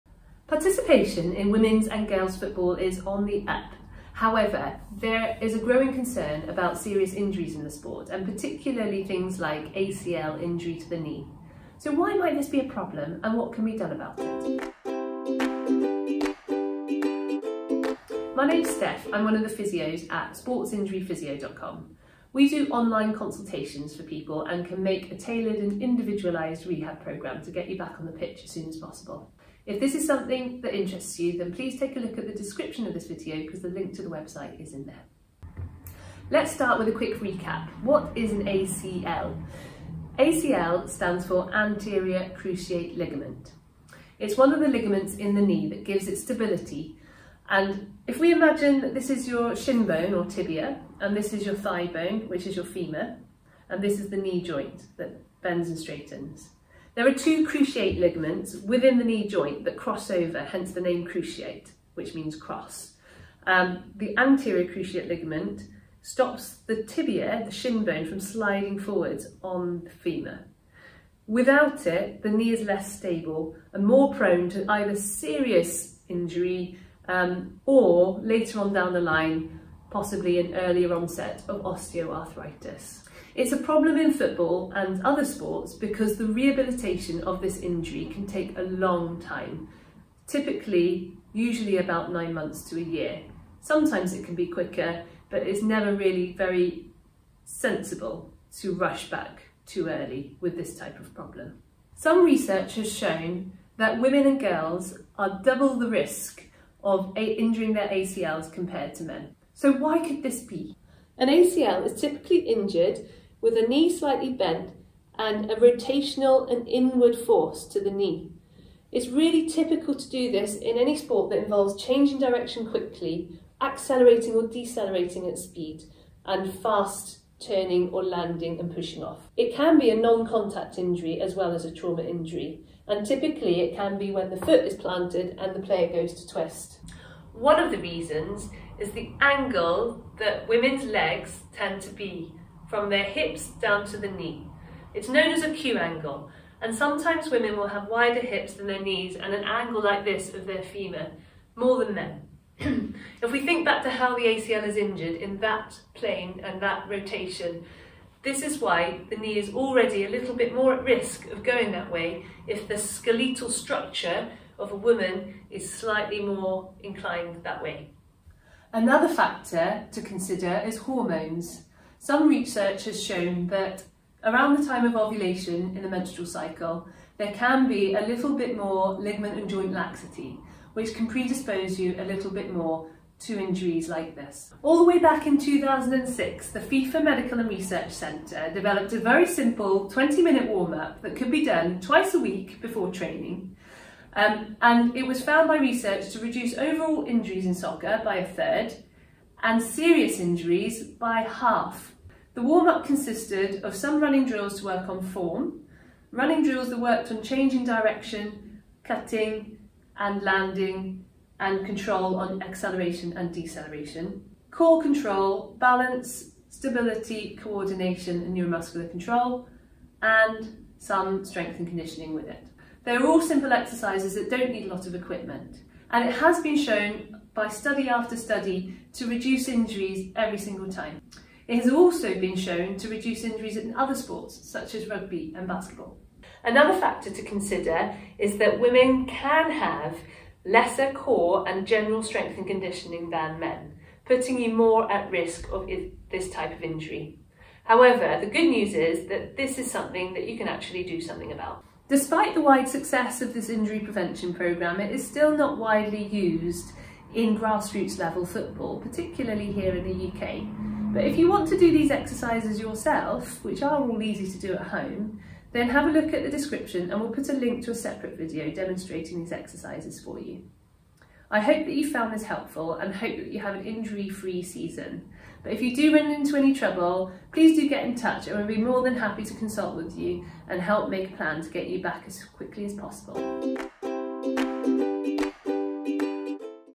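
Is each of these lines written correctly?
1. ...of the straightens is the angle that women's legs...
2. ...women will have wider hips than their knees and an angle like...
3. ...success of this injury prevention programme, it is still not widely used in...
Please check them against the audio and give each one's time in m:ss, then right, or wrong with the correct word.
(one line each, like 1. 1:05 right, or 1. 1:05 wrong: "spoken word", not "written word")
1. 2:17 wrong: "reasons", not "straightens"
2. 2:27 right
3. 4:12 right.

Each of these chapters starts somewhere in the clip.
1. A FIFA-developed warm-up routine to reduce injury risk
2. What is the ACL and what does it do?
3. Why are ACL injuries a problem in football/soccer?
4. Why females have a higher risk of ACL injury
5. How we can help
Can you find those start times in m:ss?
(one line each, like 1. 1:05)
1. 3:05
2. 0:35
3. 1:23
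4. 1:42
5. 4:31.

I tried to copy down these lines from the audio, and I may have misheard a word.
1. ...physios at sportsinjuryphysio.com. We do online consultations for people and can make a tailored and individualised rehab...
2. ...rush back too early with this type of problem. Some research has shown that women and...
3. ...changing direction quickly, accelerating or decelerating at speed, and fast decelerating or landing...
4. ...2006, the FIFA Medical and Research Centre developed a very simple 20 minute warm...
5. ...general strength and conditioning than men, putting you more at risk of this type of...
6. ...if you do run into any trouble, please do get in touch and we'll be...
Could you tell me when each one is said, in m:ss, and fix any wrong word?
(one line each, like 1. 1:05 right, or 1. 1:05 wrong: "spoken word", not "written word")
1. 0:19 right
2. 1:38 right
3. 2:01 wrong: "turning", not "decelerating"
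4. 3:05 right
5. 4:01 right
6. 4:35 right.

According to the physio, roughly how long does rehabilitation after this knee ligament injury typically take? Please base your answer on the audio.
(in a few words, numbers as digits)
9 months to a year.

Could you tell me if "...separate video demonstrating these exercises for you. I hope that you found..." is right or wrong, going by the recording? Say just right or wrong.
right.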